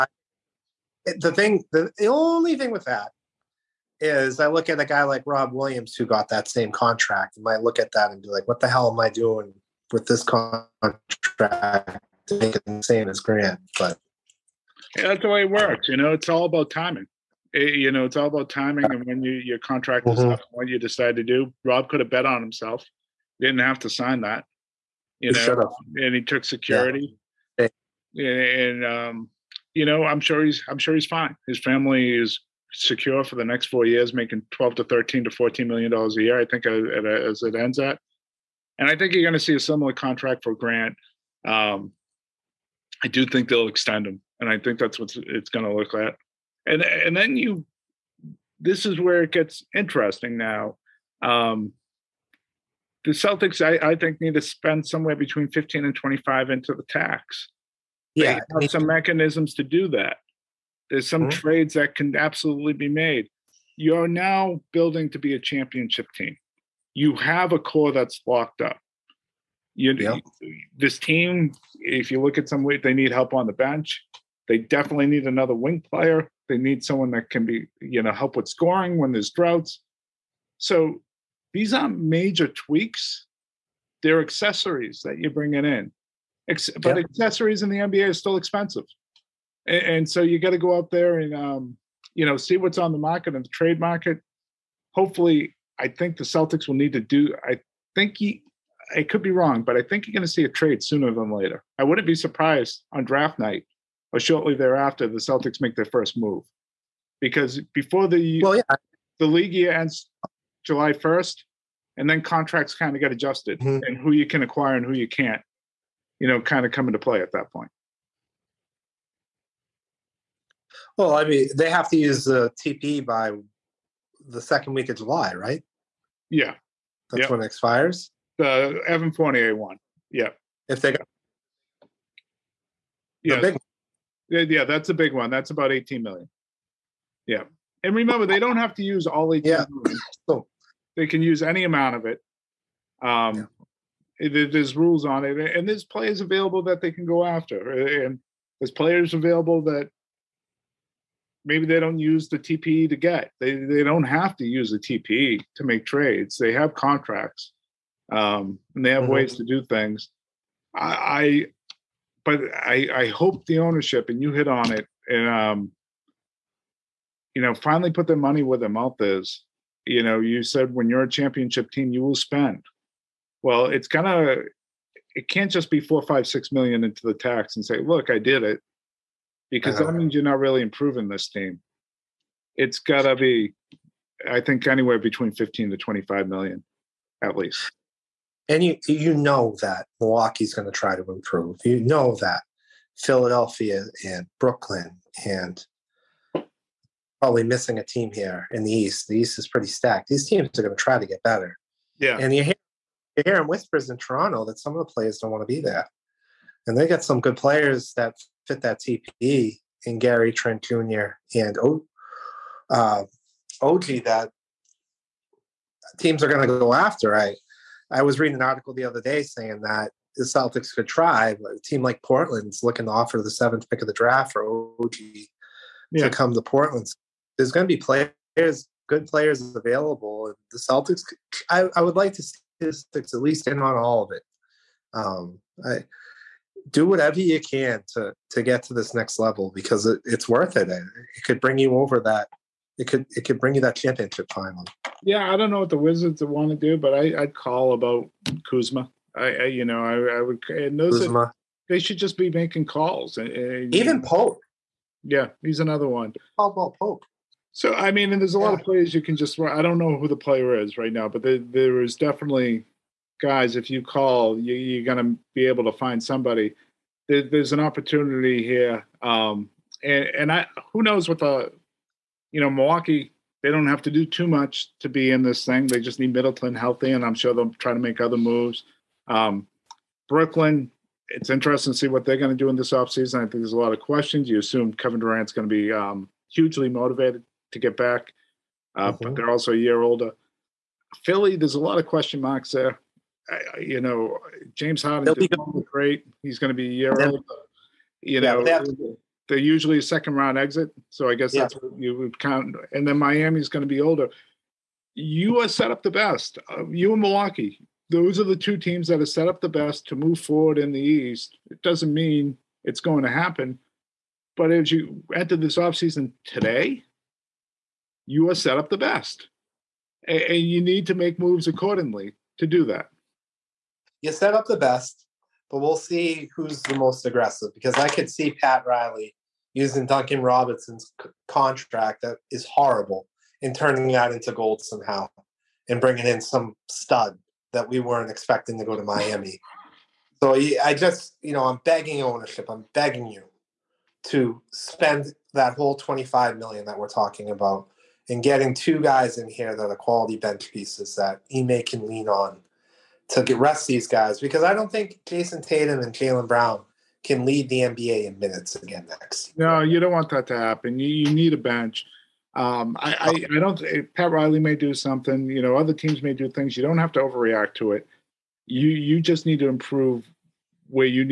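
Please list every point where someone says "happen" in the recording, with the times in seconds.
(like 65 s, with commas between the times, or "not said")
313 s, 360 s.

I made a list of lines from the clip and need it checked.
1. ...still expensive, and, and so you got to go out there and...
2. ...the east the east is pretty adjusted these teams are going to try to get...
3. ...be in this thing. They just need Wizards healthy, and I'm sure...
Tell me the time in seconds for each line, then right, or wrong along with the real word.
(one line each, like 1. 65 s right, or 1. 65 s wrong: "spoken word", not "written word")
1. 88 s right
2. 198 s wrong: "stacked", not "adjusted"
3. 274 s wrong: "Middleton", not "Wizards".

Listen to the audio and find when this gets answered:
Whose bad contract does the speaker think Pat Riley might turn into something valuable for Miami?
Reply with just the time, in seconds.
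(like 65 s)
329 s.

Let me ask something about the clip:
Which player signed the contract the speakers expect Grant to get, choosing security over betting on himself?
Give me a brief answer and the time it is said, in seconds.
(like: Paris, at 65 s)
Rob Williams, at 5 s.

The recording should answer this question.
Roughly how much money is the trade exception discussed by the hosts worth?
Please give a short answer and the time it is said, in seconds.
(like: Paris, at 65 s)
18 million, at 135 s.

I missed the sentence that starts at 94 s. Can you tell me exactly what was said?
Hopefully, I think the Celtics will need to do.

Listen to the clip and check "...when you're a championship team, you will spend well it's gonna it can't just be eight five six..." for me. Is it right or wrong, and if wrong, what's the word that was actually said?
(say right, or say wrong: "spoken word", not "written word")
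wrong: "four", not "eight".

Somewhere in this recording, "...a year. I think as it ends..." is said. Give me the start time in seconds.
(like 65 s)
36 s.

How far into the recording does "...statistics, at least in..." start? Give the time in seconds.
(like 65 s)
232 s.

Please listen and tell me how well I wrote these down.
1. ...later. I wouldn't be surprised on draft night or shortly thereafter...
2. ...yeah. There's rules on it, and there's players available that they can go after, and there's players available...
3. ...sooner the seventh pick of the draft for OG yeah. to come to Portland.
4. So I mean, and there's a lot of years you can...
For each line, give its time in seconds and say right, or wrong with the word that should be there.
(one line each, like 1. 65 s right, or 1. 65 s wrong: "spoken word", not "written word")
1. 101 s right
2. 143 s right
3. 222 s wrong: "offer", not "sooner"
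4. 257 s wrong: "players", not "years".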